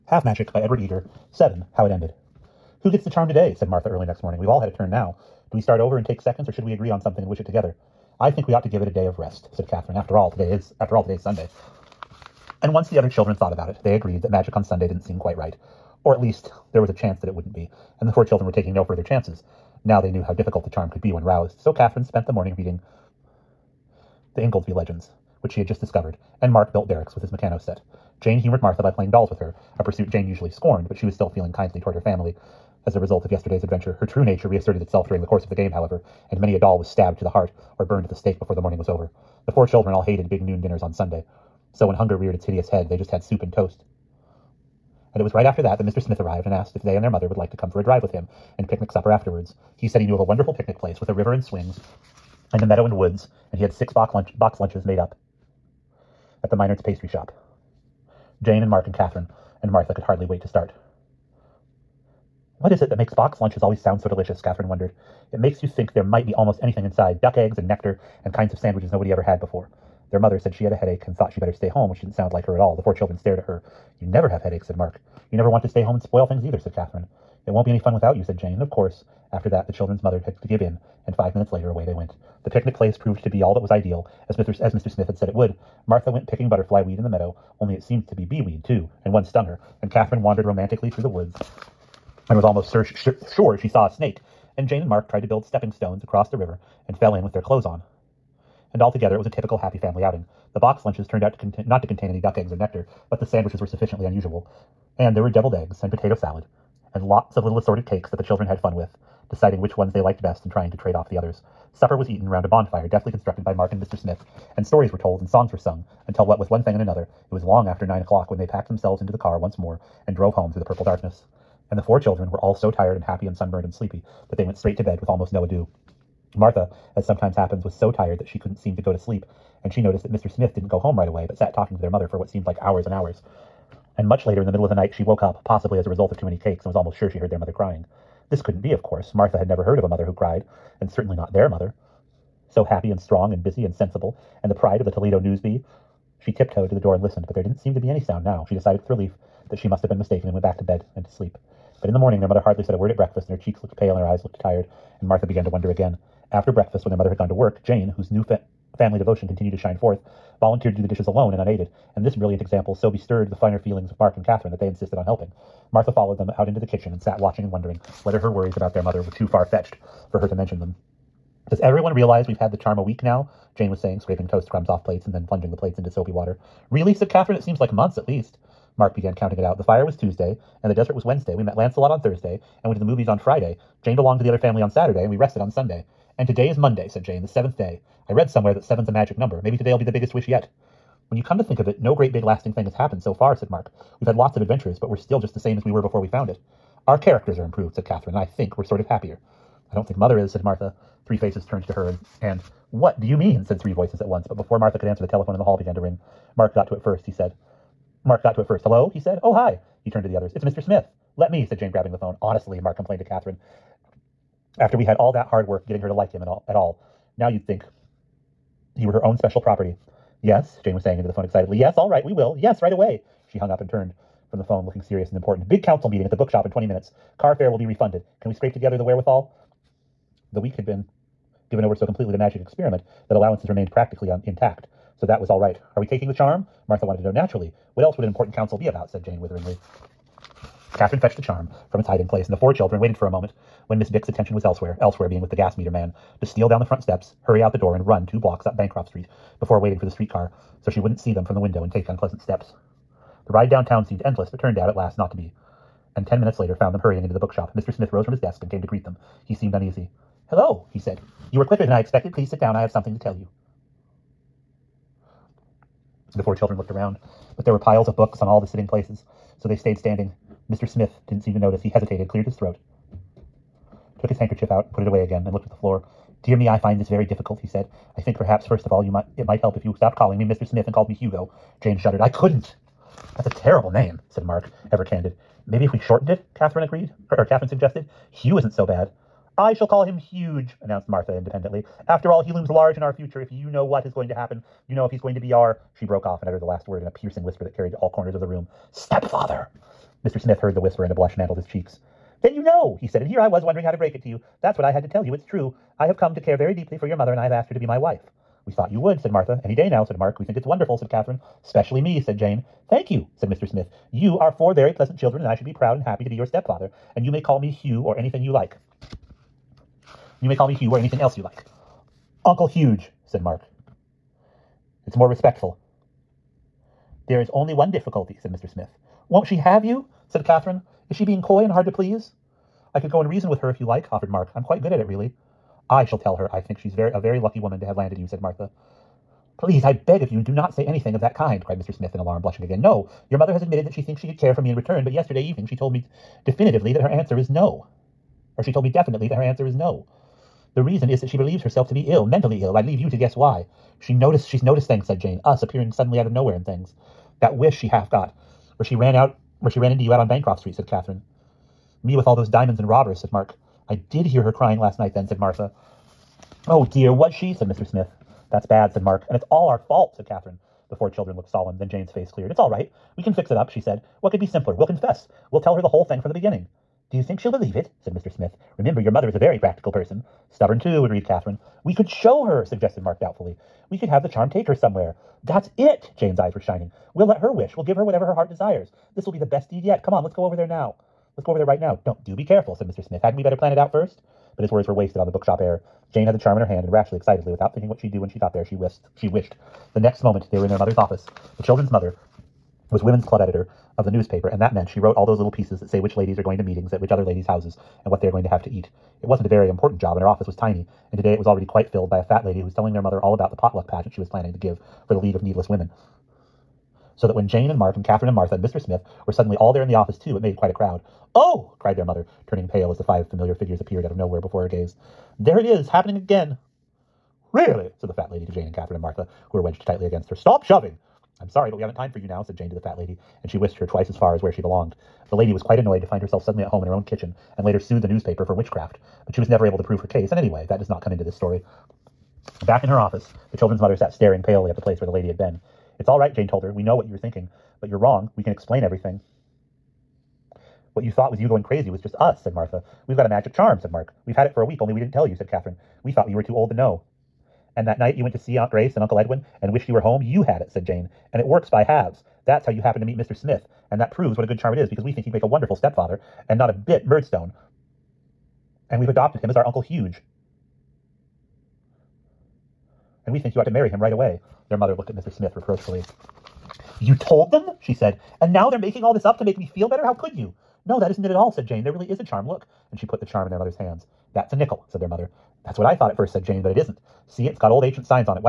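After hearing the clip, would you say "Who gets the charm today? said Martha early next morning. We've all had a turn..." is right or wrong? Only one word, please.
right.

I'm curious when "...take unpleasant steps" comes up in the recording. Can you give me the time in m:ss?
4:11.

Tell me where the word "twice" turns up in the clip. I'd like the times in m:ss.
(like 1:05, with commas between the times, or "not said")
7:13.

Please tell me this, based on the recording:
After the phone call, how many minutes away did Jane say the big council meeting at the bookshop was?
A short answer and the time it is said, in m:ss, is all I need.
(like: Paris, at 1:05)
20, at 3:46.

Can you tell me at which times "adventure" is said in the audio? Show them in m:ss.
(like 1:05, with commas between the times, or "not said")
0:33, 3:14.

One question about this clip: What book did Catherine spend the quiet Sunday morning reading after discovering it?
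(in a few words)
The Ingoldsby Legends.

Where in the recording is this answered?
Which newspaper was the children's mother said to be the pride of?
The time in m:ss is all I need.
2:24.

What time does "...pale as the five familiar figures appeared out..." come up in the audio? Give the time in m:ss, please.
7:02.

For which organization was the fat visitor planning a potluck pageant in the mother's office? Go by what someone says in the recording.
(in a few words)
League of Needless Women.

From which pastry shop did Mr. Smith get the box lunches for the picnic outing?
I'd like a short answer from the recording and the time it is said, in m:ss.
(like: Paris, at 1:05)
Minard's, at 0:56.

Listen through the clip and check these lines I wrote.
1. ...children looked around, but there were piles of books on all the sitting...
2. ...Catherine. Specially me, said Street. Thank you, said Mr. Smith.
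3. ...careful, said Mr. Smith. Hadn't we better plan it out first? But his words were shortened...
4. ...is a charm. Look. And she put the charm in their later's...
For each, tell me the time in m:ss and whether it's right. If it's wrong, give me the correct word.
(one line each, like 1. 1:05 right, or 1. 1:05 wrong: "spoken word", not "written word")
1. 4:26 right
2. 5:10 wrong: "Jane", not "Street"
3. 6:32 wrong: "wasted", not "shortened"
4. 8:01 wrong: "mother", not "later".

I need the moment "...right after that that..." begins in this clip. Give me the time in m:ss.
0:45.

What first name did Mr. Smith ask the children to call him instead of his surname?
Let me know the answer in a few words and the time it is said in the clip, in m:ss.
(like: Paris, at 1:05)
Hugo, at 4:40.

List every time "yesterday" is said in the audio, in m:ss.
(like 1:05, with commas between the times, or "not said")
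0:33, 5:44.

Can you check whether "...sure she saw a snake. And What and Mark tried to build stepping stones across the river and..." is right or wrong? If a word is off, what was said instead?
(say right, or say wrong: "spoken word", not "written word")
wrong: "Jane", not "What".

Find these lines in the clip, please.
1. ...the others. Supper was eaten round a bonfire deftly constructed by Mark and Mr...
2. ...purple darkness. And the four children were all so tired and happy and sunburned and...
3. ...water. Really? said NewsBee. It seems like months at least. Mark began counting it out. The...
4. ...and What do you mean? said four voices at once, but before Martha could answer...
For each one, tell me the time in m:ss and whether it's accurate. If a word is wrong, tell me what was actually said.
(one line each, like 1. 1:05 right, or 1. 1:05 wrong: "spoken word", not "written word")
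1. 1:51 right
2. 2:00 right
3. 2:56 wrong: "Catherine", not "NewsBee"
4. 3:22 wrong: "three", not "four".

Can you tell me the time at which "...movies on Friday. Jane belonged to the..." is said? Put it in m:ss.
3:02.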